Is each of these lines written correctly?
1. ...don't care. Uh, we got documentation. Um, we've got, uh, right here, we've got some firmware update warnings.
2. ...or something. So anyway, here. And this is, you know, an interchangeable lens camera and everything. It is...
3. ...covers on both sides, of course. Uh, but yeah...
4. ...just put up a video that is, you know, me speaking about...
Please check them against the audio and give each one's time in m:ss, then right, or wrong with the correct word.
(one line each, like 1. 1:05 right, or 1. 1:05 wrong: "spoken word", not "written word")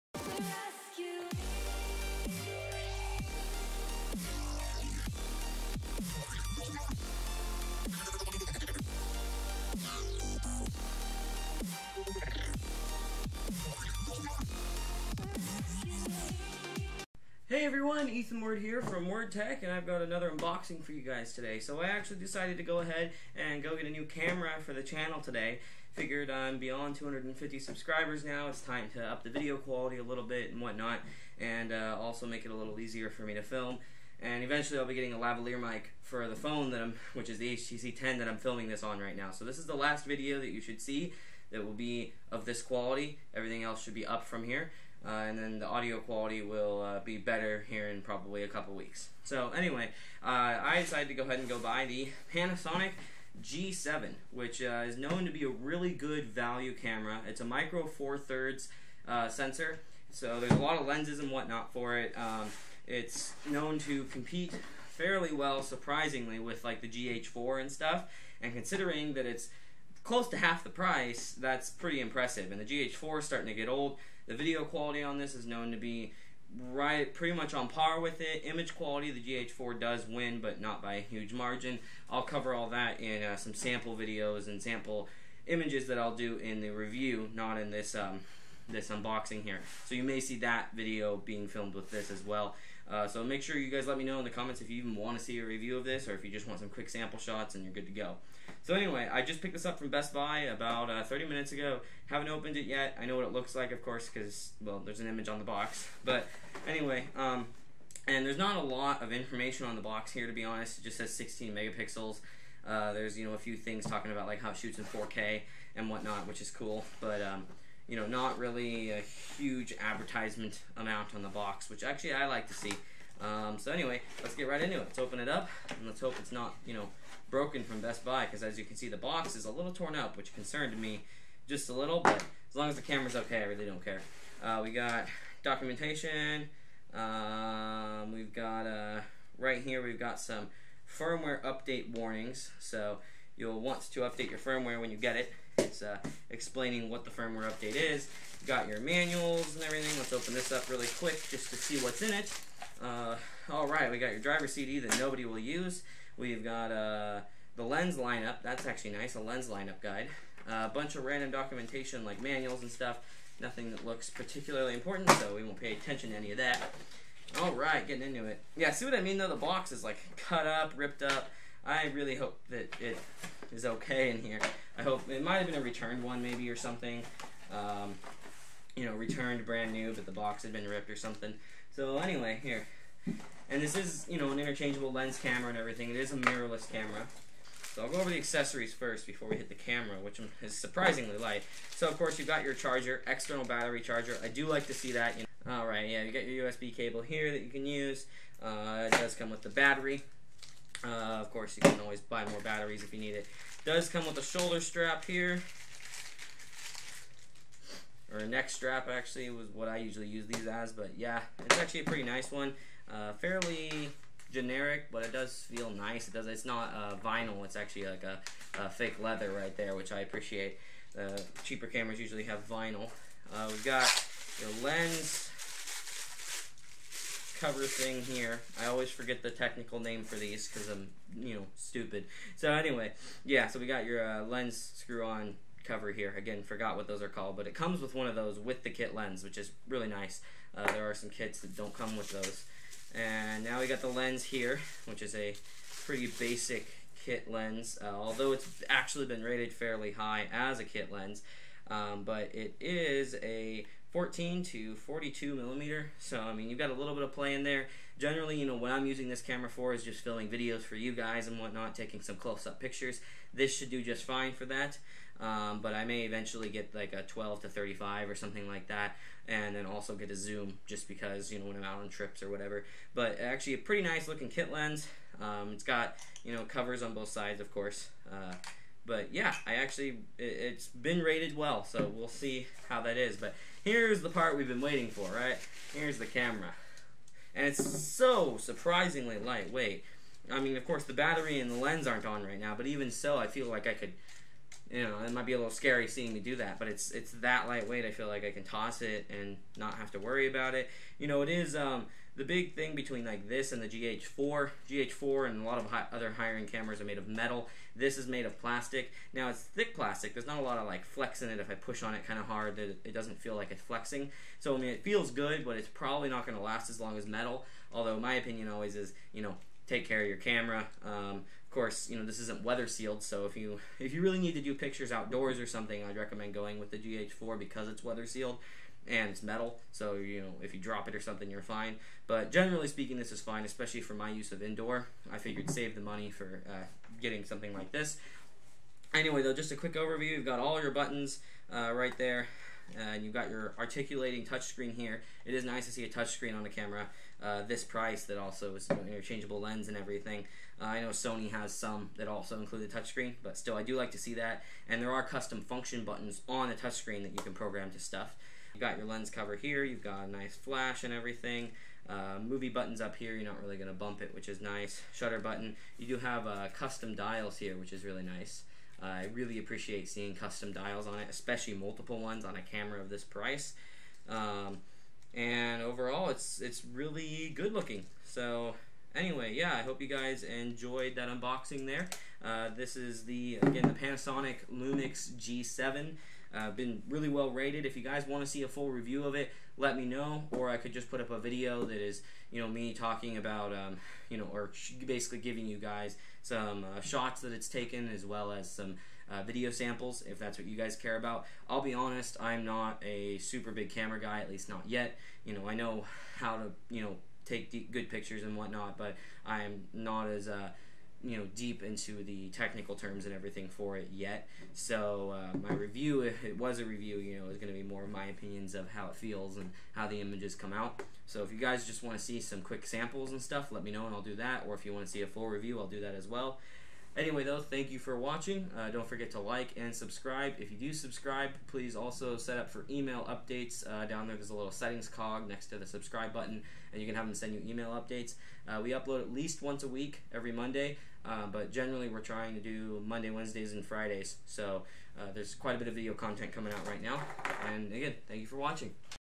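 1. 2:13 right
2. 3:00 right
3. 4:36 right
4. 6:30 wrong: "talking", not "speaking".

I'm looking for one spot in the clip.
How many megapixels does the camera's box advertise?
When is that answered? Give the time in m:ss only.
1:51.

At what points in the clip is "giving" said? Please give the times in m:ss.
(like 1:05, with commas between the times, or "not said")
6:35.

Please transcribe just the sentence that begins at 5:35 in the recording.
I figured save the money for uh, getting something like this.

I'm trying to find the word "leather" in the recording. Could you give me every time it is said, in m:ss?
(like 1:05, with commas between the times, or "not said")
3:39.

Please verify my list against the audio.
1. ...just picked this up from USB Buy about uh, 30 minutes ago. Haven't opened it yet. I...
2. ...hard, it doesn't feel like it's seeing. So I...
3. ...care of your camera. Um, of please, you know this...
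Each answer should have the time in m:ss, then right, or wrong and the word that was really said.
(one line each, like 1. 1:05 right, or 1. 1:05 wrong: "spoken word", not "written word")
1. 1:39 wrong: "Best", not "USB"
2. 5:12 wrong: "flexing", not "seeing"
3. 5:19 wrong: "course", not "please".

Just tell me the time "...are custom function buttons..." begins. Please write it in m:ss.
5:54.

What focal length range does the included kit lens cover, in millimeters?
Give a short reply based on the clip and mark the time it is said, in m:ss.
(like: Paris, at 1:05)
14 to 42, at 4:13.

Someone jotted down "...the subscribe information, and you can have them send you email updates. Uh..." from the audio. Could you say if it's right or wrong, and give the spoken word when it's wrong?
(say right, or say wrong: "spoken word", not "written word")
wrong: "button", not "information".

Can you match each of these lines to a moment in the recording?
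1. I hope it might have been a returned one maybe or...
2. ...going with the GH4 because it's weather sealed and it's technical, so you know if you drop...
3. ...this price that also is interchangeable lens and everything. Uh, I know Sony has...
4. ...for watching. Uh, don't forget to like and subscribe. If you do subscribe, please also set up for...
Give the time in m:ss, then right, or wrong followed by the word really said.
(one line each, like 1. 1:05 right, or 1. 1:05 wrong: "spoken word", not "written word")
1. 2:54 right
2. 5:26 wrong: "metal", not "technical"
3. 5:47 right
4. 7:07 right.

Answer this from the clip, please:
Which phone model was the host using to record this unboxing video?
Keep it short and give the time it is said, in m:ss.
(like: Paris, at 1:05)
HTC 10, at 0:37.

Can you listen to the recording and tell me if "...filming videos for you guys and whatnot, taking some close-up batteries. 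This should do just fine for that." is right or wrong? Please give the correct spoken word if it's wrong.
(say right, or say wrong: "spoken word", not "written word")
wrong: "pictures", not "batteries".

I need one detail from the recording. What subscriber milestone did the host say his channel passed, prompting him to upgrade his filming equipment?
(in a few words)
250.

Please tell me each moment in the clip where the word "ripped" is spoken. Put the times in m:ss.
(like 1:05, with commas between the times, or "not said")
2:50, 3:00.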